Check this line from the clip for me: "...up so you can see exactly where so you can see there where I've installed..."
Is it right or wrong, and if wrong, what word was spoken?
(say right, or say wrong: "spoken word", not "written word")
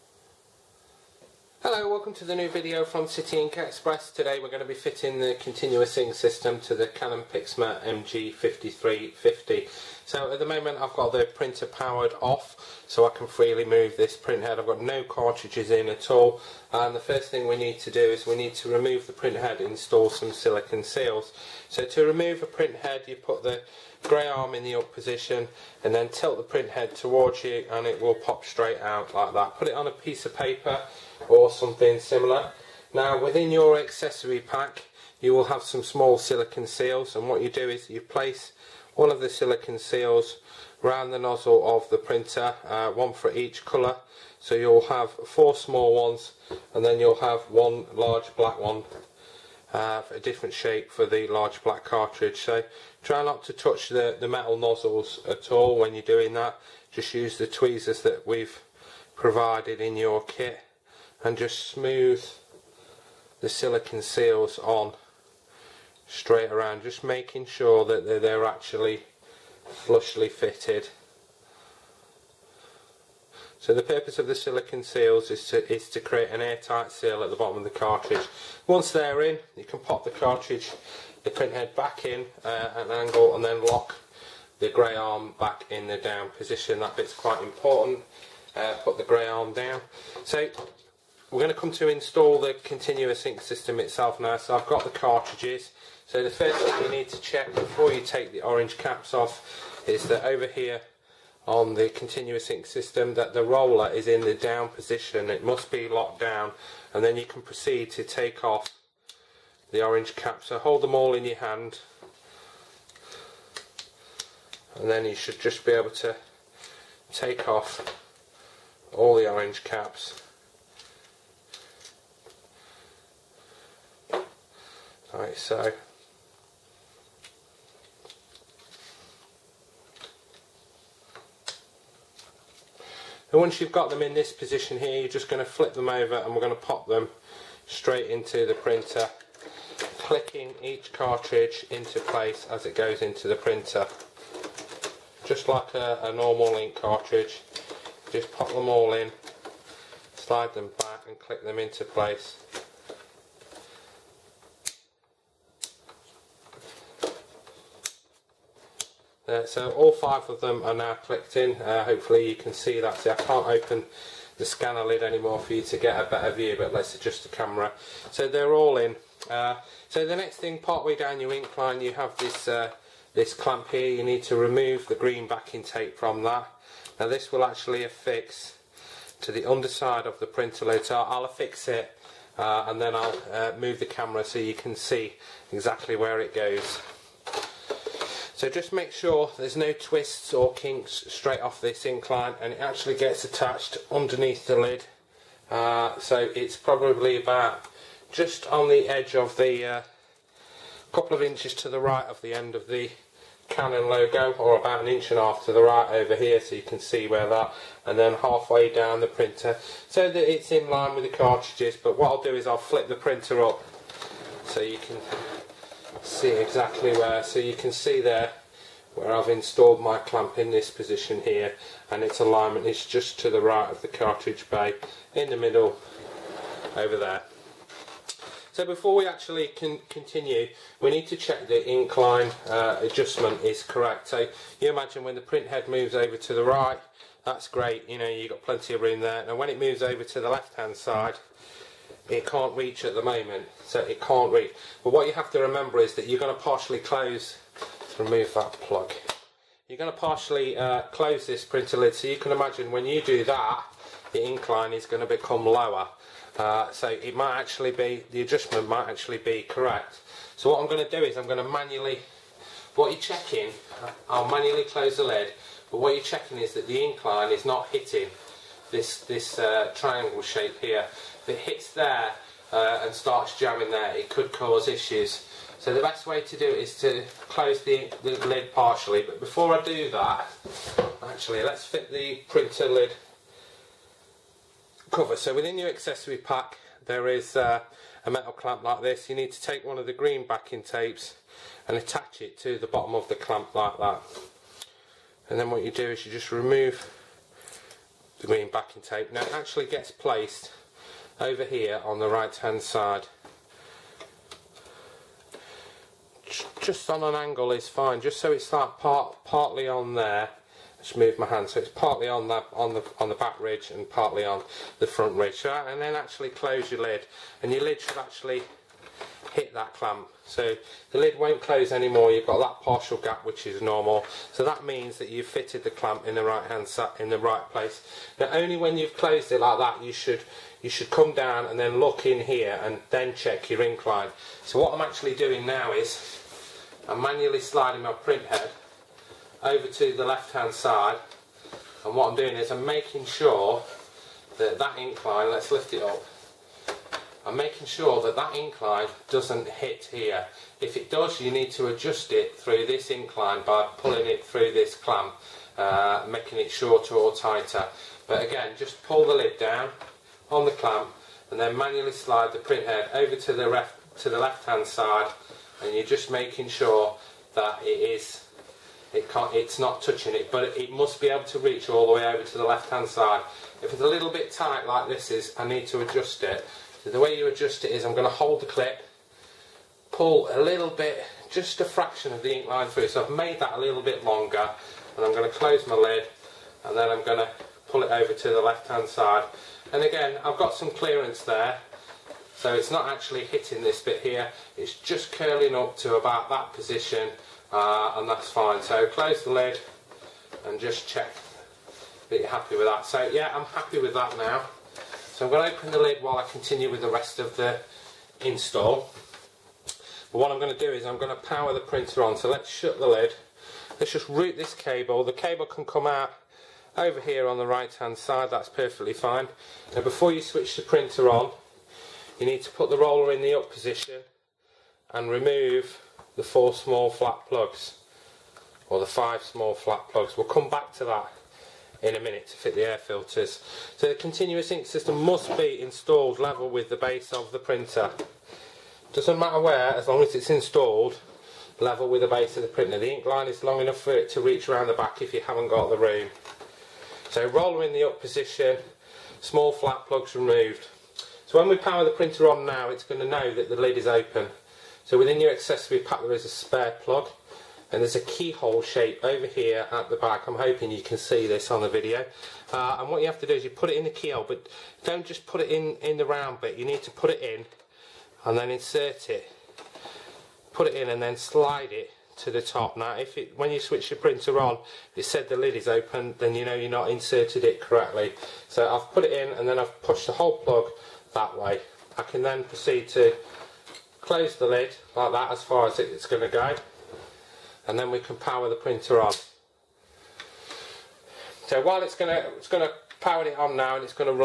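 right.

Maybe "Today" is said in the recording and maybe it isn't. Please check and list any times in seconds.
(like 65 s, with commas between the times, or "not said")
4 s.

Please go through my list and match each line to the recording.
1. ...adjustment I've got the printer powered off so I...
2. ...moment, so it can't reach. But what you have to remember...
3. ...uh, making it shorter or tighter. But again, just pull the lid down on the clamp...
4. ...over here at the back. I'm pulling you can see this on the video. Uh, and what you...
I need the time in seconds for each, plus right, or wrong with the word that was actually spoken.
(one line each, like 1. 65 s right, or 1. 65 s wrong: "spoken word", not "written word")
1. 10 s wrong: "moment", not "adjustment"
2. 243 s right
3. 355 s right
4. 459 s wrong: "hoping", not "pulling".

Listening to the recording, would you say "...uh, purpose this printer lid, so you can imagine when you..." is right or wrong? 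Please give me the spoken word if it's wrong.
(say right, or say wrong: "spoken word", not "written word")
wrong: "close", not "purpose".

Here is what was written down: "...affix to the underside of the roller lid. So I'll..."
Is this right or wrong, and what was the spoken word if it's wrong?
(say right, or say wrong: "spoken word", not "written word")
wrong: "printer", not "roller".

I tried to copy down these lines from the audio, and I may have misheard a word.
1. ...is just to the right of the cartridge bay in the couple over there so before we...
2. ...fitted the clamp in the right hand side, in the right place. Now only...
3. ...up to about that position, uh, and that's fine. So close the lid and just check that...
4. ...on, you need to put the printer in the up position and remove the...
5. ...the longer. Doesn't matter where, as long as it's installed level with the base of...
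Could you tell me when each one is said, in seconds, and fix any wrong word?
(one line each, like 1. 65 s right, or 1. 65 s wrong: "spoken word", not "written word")
1. 222 s wrong: "middle", not "couple"
2. 325 s right
3. 395 s right
4. 421 s wrong: "roller", not "printer"
5. 437 s wrong: "printer", not "longer".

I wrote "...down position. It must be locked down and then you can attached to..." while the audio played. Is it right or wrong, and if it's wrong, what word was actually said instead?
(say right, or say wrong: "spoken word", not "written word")
wrong: "proceed", not "attached".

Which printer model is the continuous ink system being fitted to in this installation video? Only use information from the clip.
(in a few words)
Canon Pixma MG5350.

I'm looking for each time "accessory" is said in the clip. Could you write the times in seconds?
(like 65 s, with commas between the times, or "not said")
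33 s, 285 s, 455 s.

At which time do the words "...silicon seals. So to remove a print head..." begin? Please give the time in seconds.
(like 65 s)
20 s.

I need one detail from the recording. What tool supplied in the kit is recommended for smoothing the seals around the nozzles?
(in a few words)
tweezers.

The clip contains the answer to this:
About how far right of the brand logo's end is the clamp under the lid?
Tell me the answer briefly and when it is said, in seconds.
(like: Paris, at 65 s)
an inch and a half, at 204 s.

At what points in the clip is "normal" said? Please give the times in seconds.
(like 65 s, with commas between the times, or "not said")
146 s, 323 s.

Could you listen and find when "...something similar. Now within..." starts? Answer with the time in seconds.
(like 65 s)
31 s.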